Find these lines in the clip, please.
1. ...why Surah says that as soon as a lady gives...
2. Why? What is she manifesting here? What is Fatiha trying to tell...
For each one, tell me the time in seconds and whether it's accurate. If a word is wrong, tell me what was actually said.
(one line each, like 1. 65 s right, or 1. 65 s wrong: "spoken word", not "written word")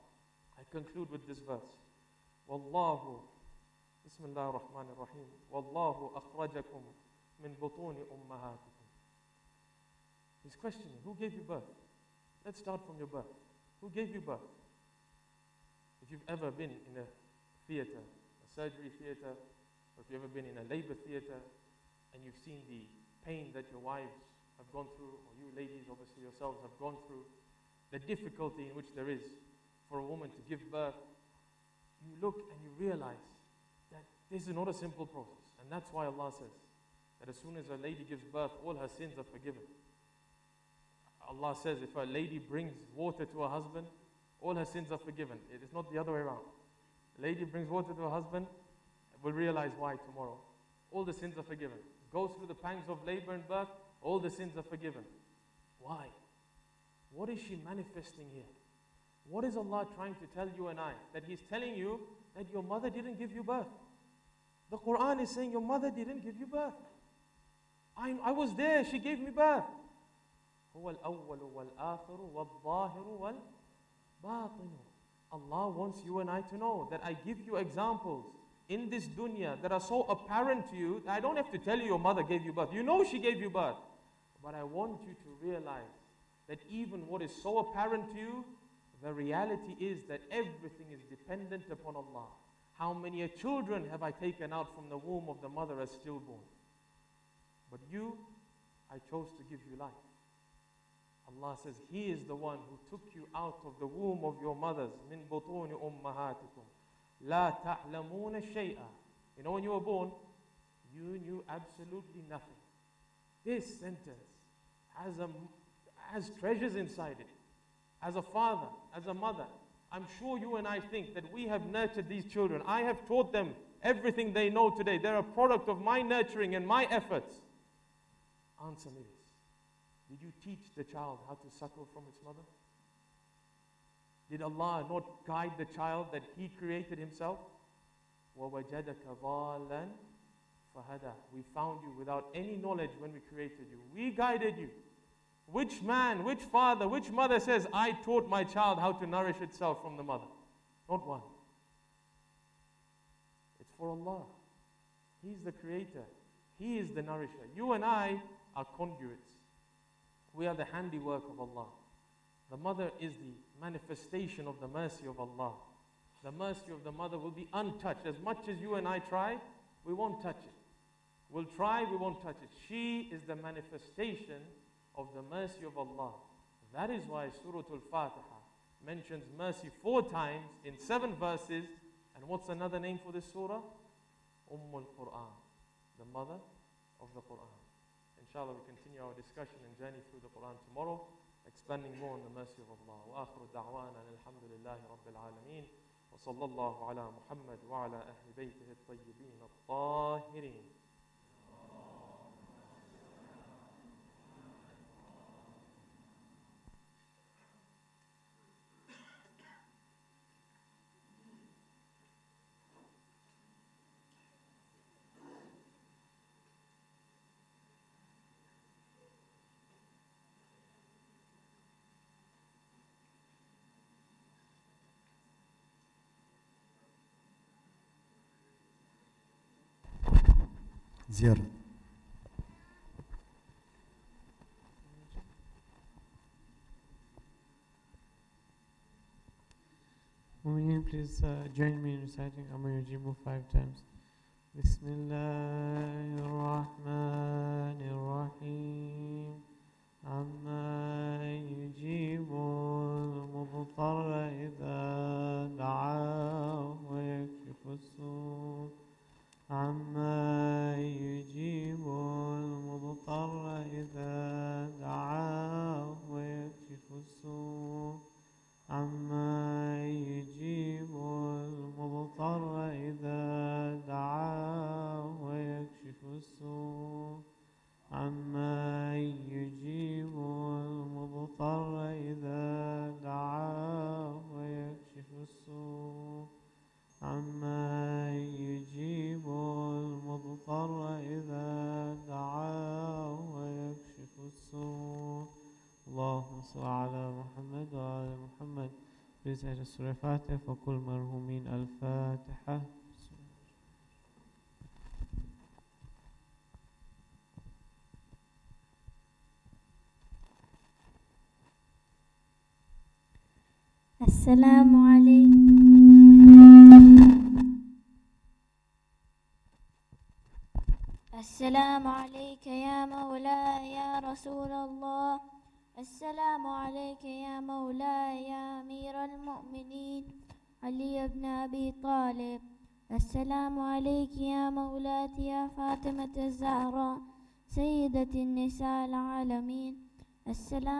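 1. 35 s wrong: "Allah", not "Surah"
2. 55 s wrong: "Allah", not "Fatiha".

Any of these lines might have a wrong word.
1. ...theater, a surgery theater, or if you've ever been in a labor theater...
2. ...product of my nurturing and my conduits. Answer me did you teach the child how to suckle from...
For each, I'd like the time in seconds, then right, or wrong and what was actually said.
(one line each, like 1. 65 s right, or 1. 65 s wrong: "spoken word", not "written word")
1. 17 s right
2. 125 s wrong: "efforts", not "conduits".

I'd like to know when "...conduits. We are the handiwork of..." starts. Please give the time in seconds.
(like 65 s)
158 s.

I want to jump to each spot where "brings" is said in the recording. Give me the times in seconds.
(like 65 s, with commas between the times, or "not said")
42 s, 47 s.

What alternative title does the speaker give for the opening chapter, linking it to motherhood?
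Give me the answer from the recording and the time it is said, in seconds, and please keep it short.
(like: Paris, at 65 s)
Mother of the Quran, at 185 s.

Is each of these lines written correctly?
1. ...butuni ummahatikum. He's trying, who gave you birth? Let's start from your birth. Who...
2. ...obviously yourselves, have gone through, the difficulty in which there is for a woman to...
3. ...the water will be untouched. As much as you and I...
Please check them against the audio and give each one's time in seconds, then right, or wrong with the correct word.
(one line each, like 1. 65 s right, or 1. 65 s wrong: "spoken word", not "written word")
1. 7 s wrong: "questioning", not "trying"
2. 25 s right
3. 166 s wrong: "mother", not "water".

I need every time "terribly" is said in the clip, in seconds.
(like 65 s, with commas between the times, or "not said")
not said.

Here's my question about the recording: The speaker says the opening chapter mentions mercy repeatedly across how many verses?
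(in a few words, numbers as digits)
7.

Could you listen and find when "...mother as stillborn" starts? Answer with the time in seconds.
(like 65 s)
95 s.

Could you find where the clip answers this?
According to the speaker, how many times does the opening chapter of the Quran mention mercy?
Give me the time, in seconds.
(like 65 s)
179 s.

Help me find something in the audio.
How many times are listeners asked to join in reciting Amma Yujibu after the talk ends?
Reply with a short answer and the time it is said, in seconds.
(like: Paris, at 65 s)
5, at 243 s.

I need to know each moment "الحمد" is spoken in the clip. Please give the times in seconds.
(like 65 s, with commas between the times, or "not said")
194 s.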